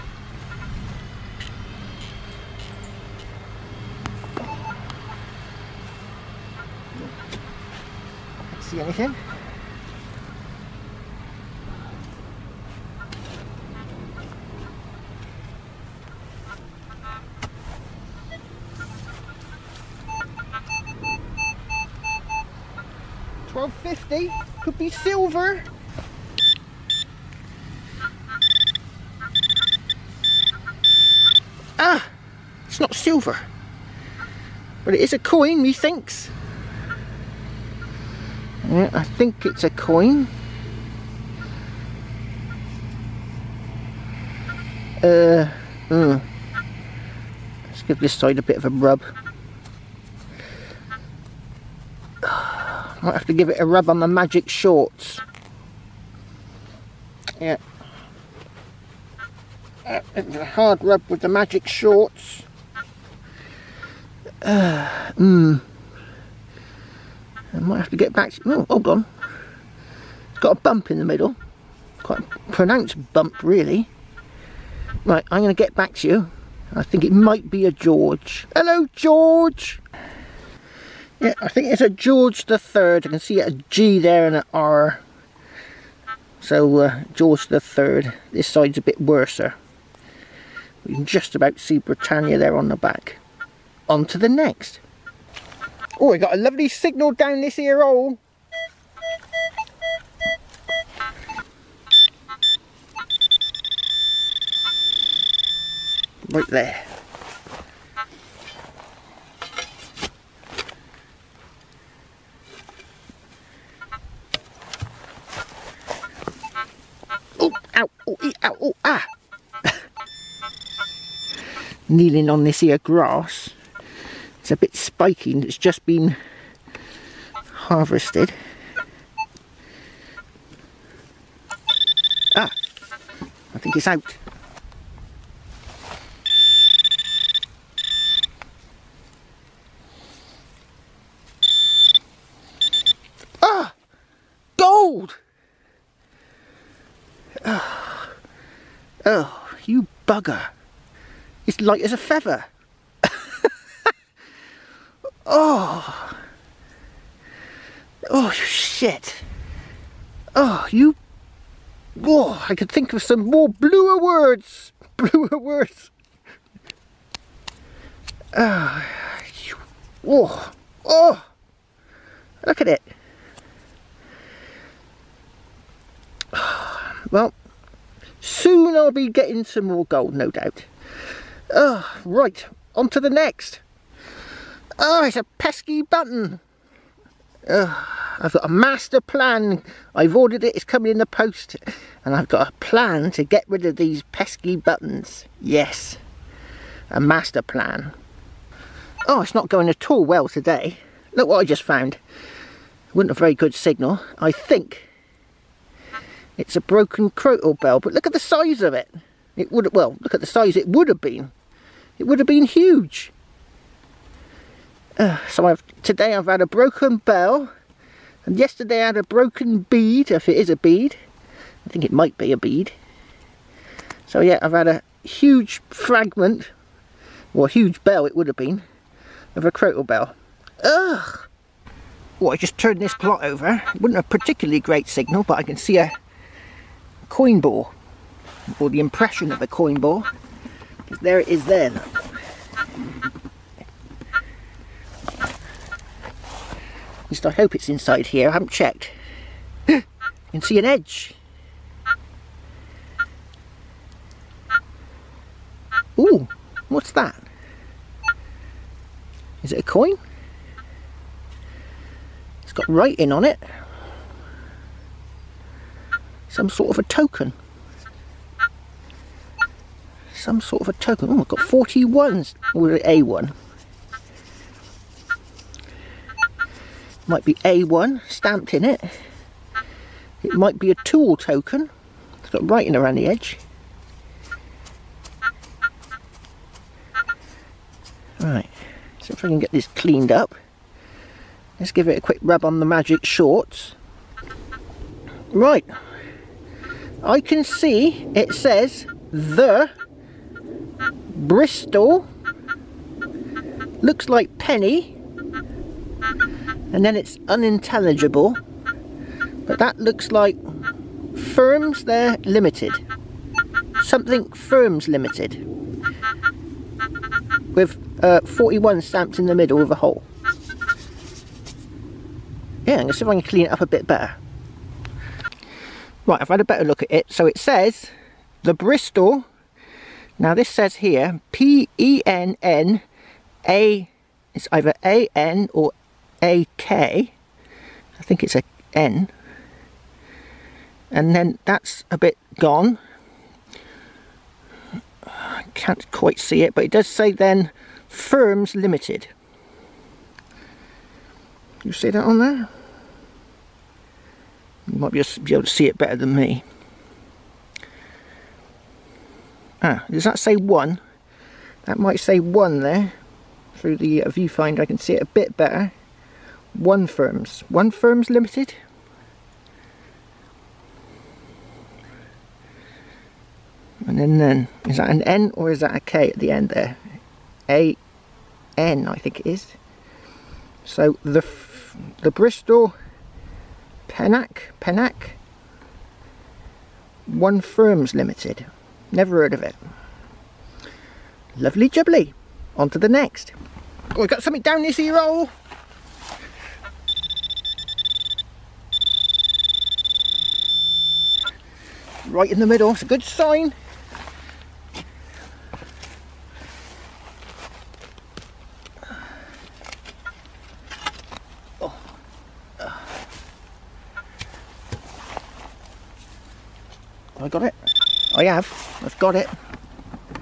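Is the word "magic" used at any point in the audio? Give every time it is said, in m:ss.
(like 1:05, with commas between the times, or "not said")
0:54, 1:01, 4:52.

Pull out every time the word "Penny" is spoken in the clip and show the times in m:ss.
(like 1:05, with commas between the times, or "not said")
5:04.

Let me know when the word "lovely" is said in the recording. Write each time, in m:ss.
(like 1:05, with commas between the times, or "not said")
1:36, 6:31.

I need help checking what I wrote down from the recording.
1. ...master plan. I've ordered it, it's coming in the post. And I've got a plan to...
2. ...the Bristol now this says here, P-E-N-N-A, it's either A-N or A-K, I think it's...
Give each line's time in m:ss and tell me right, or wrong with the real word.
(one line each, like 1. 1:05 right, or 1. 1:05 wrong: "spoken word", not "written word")
1. 3:08 right
2. 5:28 right.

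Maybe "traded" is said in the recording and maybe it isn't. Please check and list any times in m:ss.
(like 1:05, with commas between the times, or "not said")
not said.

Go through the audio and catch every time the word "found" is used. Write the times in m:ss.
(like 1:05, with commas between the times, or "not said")
3:21.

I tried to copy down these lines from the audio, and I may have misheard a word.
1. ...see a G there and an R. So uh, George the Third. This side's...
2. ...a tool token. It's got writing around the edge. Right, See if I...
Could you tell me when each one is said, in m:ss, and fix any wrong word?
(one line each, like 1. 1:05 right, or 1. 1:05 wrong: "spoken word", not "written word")
1. 1:23 right
2. 4:40 right.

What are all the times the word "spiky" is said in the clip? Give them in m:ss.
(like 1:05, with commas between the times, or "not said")
2:04.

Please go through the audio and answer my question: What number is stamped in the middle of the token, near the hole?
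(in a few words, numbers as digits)
41.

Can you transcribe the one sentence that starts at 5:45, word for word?
I can't quite see it, but it does say then, Firms Limited.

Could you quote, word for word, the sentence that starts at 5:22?
Yeah, I'm going to see if I can clean it up a bit better.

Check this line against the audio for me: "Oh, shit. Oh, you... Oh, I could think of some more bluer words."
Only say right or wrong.
right.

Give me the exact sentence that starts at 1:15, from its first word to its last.
Right, I'm going to get back to you.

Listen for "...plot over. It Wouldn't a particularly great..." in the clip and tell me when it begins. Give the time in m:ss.
3:52.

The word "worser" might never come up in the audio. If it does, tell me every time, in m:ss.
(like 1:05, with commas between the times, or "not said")
1:29.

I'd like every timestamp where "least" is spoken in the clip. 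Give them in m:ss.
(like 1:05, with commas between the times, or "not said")
4:07.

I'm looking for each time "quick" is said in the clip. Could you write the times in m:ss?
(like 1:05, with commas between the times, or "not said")
4:52.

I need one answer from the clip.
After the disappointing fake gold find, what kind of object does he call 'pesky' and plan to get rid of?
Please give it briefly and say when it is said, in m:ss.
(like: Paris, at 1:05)
Buttons, at 3:05.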